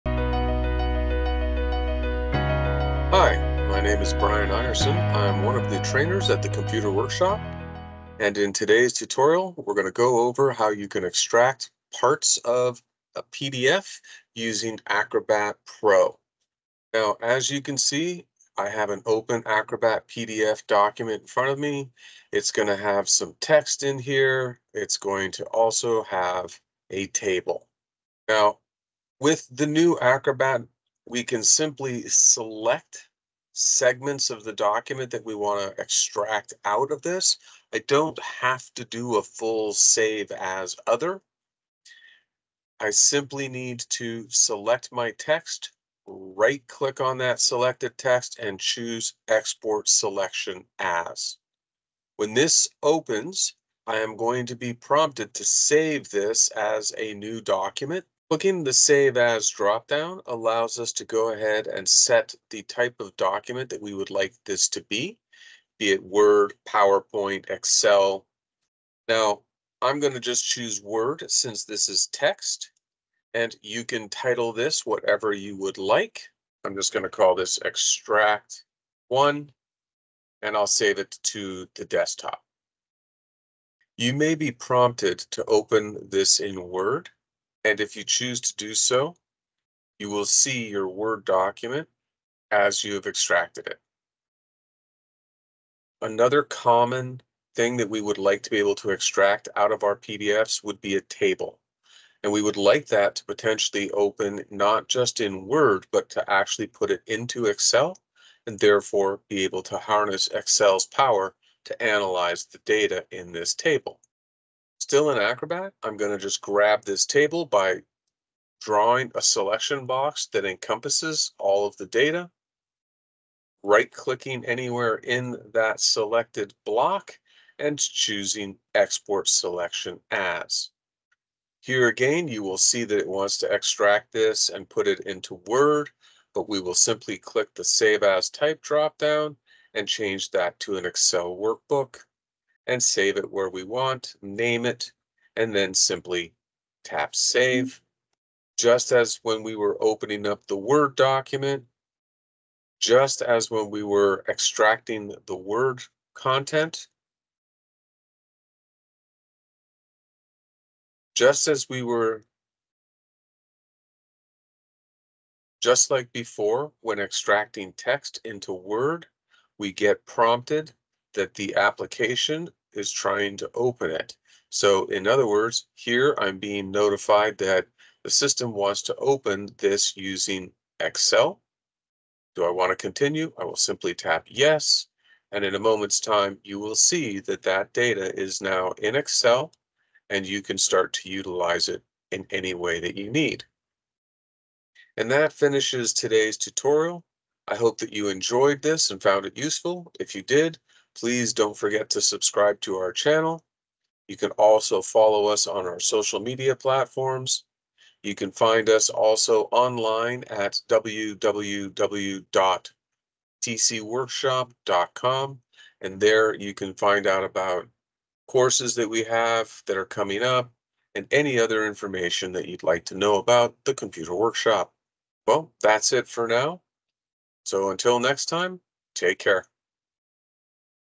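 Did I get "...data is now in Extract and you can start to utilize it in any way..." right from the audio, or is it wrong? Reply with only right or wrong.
wrong.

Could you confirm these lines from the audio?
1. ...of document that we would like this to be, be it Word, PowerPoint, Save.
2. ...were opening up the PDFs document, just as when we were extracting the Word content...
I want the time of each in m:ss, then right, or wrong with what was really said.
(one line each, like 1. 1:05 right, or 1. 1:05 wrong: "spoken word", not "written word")
1. 1:03 wrong: "Excel", not "Save"
2. 2:29 wrong: "Word", not "PDFs".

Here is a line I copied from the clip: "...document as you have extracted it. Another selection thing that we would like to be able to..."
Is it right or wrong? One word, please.
wrong.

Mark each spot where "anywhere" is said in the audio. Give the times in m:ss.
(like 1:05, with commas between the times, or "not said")
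2:04.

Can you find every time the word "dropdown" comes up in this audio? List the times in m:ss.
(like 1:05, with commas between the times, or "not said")
0:59, 2:18.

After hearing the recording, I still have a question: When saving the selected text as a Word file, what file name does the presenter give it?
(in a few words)
Extract 1.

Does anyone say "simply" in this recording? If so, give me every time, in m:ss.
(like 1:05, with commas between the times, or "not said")
0:31, 0:42, 2:16, 2:25, 3:03.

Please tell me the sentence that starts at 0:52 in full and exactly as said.
When this opens, I am going to be prompted to save this as a new document.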